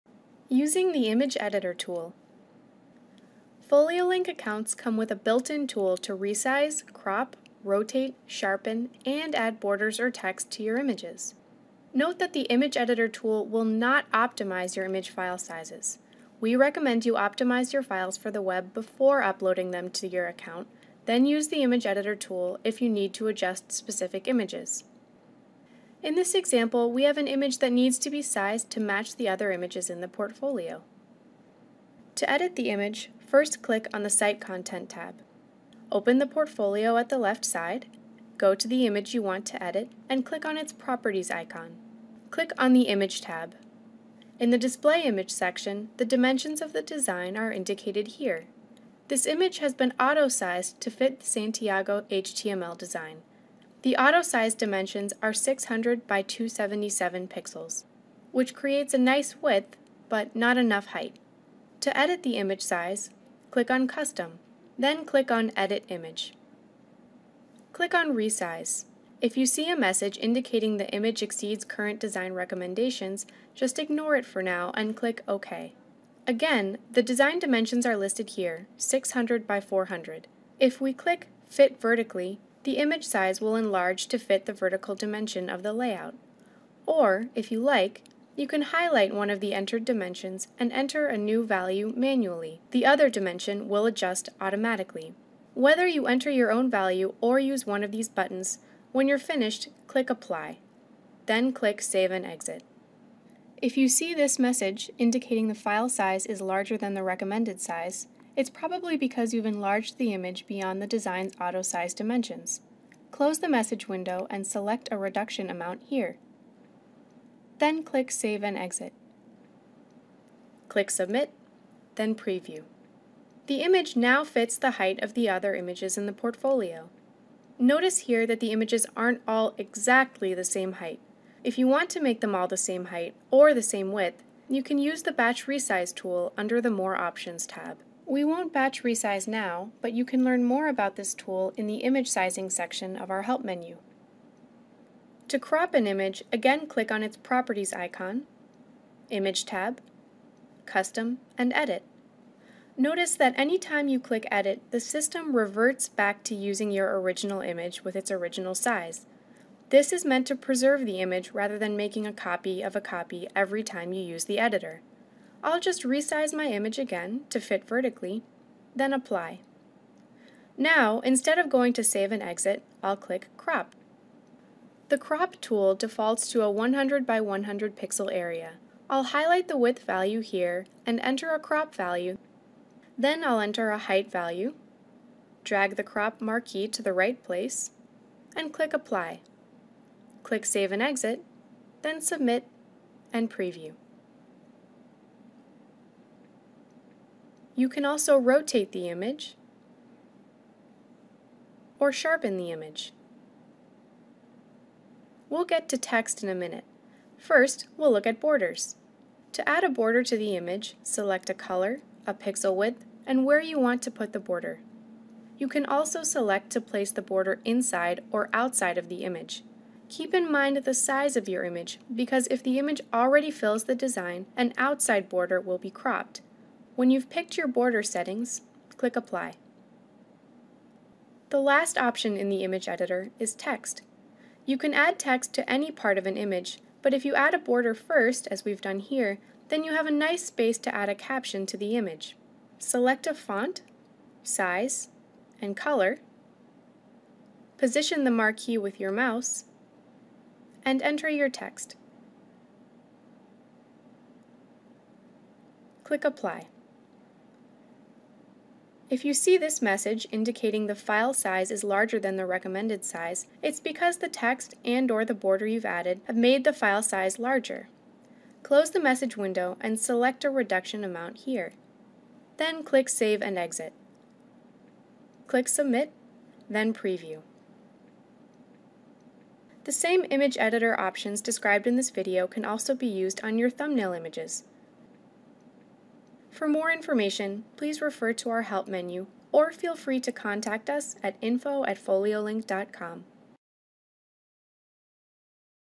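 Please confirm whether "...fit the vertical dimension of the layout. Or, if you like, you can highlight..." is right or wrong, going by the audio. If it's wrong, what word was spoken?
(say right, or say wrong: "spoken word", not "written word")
right.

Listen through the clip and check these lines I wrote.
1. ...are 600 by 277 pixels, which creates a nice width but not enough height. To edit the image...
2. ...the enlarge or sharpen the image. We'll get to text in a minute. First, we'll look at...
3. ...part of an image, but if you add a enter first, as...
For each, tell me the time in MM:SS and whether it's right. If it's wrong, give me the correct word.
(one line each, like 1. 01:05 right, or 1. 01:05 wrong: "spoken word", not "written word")
1. 00:55 right
2. 03:18 wrong: "image", not "enlarge"
3. 03:55 wrong: "border", not "enter".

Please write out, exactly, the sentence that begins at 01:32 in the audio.
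The other dimension will adjust automatically.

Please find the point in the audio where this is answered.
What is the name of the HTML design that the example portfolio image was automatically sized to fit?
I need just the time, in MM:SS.
00:51.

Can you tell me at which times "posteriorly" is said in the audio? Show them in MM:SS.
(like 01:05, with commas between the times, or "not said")
not said.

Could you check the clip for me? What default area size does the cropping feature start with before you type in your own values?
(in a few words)
100 by 100 pixels.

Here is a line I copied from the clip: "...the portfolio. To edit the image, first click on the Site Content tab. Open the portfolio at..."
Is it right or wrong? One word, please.
right.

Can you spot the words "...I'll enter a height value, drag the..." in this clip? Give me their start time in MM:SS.
03:03.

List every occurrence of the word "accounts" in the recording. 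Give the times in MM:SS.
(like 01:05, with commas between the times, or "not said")
00:04, 00:20.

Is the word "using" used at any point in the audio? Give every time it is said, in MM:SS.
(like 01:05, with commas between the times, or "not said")
00:00, 02:36.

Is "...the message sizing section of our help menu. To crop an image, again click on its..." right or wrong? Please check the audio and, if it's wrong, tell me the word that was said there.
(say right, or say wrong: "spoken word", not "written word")
wrong: "image", not "message".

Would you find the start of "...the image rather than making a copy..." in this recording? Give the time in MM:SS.
02:40.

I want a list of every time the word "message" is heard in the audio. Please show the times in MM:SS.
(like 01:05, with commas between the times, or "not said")
01:09, 01:44, 01:53, 04:19, 04:28.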